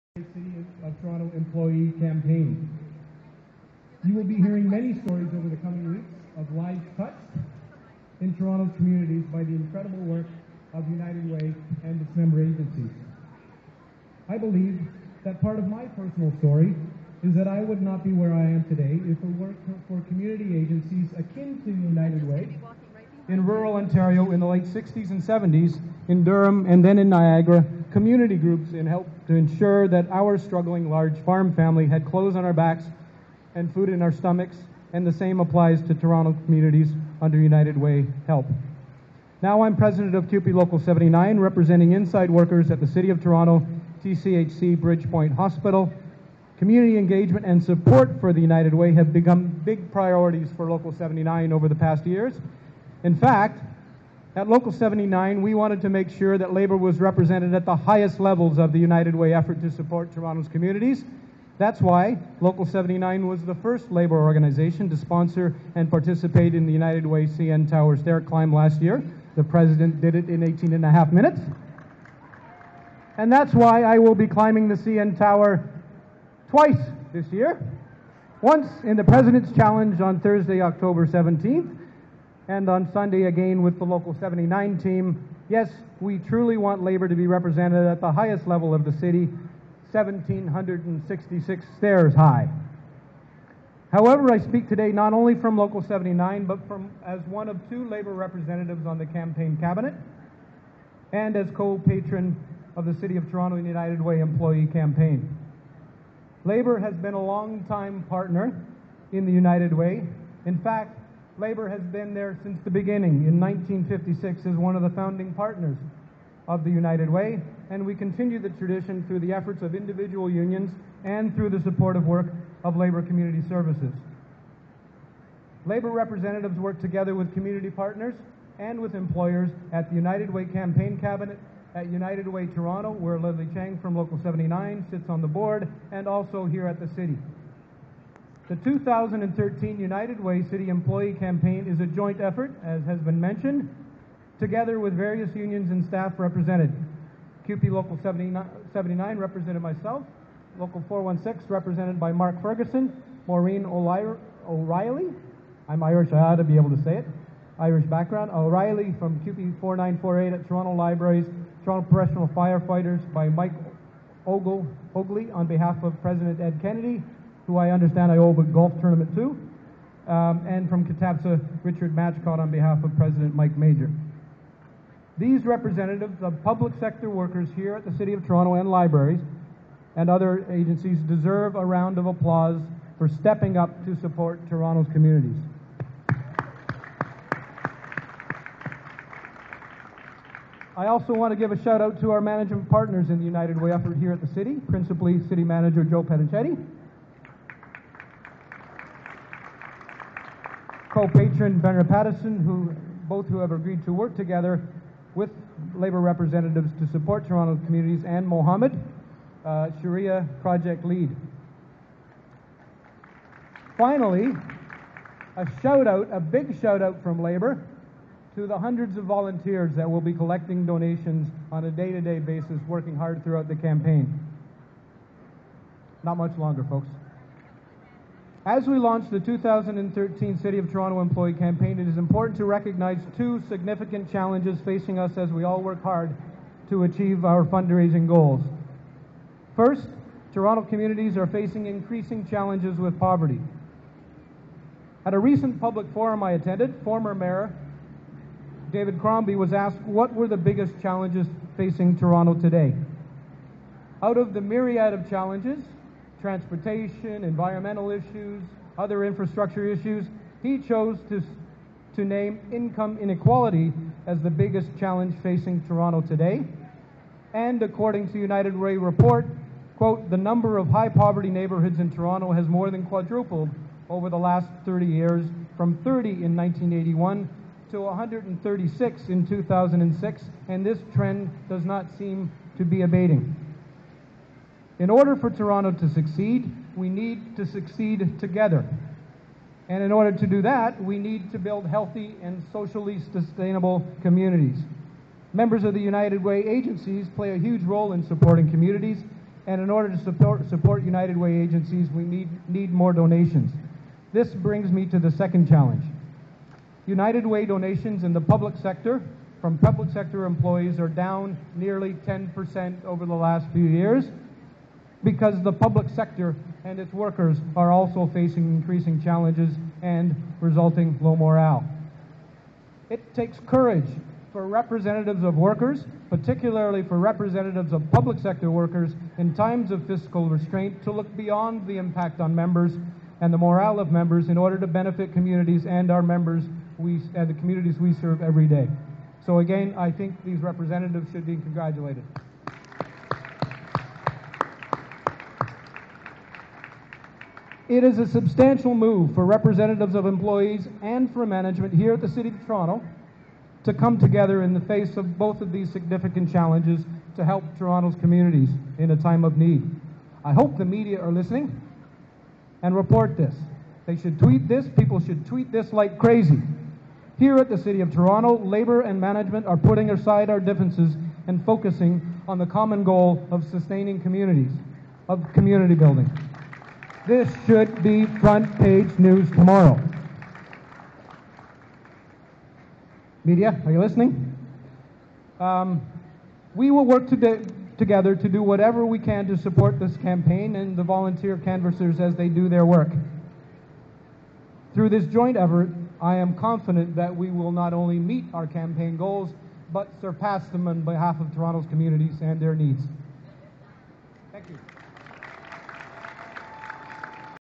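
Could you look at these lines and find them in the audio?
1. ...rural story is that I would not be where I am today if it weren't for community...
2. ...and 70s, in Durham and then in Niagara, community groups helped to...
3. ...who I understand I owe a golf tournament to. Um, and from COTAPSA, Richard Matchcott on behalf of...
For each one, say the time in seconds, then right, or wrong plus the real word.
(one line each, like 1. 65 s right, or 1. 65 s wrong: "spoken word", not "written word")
1. 15 s wrong: "personal", not "rural"
2. 25 s right
3. 167 s right.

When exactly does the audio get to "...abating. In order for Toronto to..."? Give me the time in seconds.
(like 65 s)
282 s.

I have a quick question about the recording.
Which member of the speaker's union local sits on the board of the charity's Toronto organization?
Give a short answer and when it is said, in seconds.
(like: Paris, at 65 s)
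Leslie Chang, at 133 s.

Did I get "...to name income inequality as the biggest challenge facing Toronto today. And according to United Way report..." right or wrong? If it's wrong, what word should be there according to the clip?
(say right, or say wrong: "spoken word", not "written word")
right.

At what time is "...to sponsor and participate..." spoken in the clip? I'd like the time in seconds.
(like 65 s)
64 s.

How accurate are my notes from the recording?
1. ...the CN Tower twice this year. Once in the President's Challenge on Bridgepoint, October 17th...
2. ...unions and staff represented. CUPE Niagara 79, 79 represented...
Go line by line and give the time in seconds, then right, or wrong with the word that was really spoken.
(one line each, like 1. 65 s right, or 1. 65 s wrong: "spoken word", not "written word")
1. 74 s wrong: "Thursday", not "Bridgepoint"
2. 145 s wrong: "Local", not "Niagara".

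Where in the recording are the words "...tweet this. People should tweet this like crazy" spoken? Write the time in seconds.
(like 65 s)
364 s.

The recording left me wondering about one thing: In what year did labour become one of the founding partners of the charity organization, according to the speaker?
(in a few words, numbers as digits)
1956.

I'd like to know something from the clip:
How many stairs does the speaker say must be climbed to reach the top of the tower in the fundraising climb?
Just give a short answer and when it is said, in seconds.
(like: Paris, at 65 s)
1,766, at 89 s.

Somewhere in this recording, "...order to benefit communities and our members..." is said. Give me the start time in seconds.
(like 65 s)
334 s.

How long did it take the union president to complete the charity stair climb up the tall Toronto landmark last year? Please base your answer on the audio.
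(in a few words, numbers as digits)
18 and a half minutes.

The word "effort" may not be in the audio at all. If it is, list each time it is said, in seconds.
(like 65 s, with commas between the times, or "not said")
59 s, 119 s, 142 s, 193 s, 395 s.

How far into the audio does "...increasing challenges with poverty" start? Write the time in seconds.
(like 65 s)
241 s.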